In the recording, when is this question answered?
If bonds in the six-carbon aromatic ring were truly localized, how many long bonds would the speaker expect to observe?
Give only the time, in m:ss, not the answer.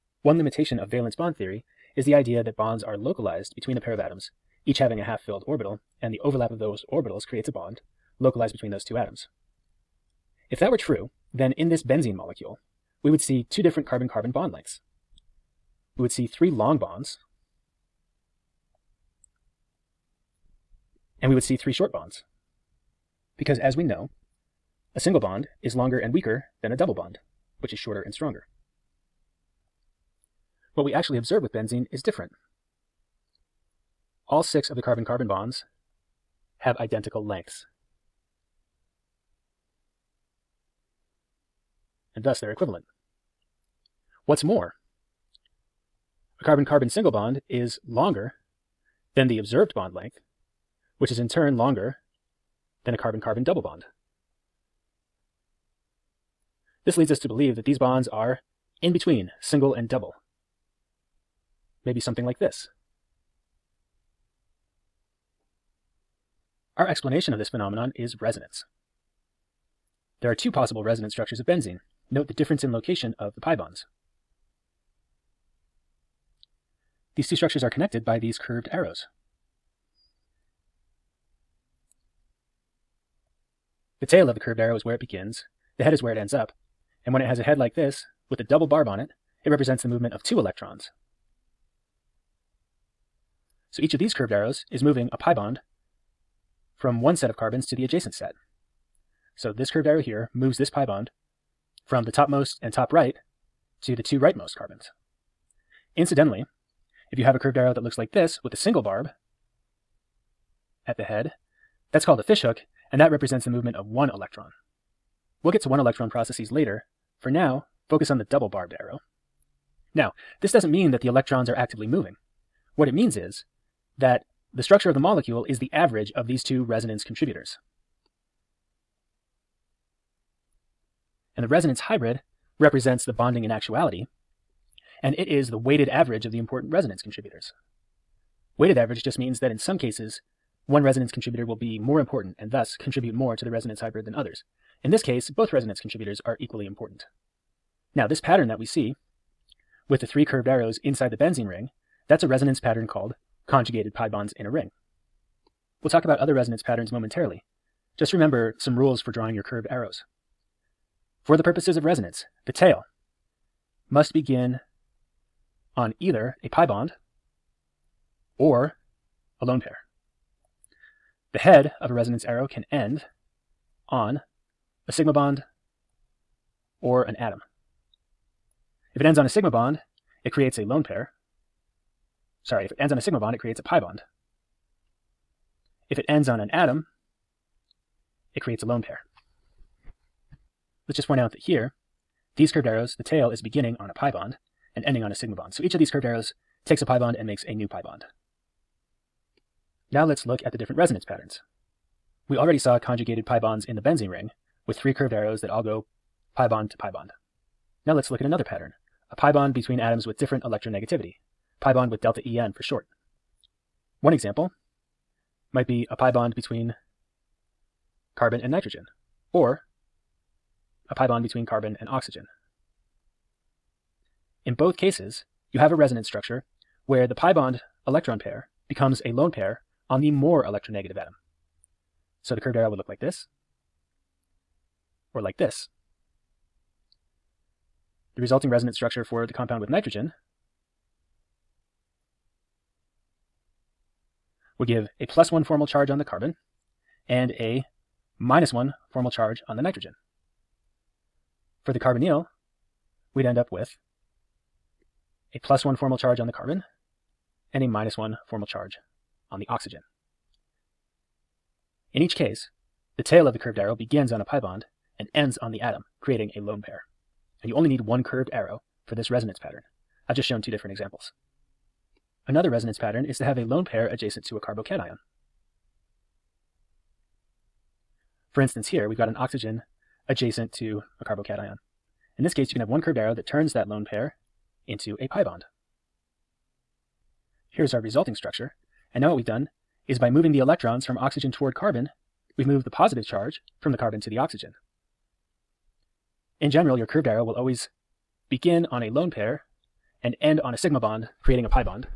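0:16.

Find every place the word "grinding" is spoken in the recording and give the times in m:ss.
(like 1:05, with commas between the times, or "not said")
not said.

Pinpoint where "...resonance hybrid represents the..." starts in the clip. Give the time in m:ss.
2:11.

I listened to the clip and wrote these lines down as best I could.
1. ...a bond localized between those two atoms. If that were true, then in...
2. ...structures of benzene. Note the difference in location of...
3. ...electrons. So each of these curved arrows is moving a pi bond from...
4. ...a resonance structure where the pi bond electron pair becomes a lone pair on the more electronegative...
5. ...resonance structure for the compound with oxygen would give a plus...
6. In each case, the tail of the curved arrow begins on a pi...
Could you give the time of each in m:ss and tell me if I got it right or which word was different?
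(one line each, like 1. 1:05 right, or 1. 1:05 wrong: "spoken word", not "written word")
1. 0:07 right
2. 1:11 right
3. 1:30 right
4. 3:45 right
5. 3:58 wrong: "nitrogen", not "oxygen"
6. 4:21 right.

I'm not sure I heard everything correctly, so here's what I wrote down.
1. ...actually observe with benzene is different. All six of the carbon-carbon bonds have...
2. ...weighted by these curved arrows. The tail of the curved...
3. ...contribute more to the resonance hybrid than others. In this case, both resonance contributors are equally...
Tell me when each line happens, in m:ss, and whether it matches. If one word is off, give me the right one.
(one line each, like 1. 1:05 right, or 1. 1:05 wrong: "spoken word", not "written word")
1. 0:30 right
2. 1:17 wrong: "connected", not "weighted"
3. 2:22 right.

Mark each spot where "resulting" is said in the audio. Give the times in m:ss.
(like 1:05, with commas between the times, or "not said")
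3:58, 4:47.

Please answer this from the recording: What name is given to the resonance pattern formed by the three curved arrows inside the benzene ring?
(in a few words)
conjugated pi bonds in a ring.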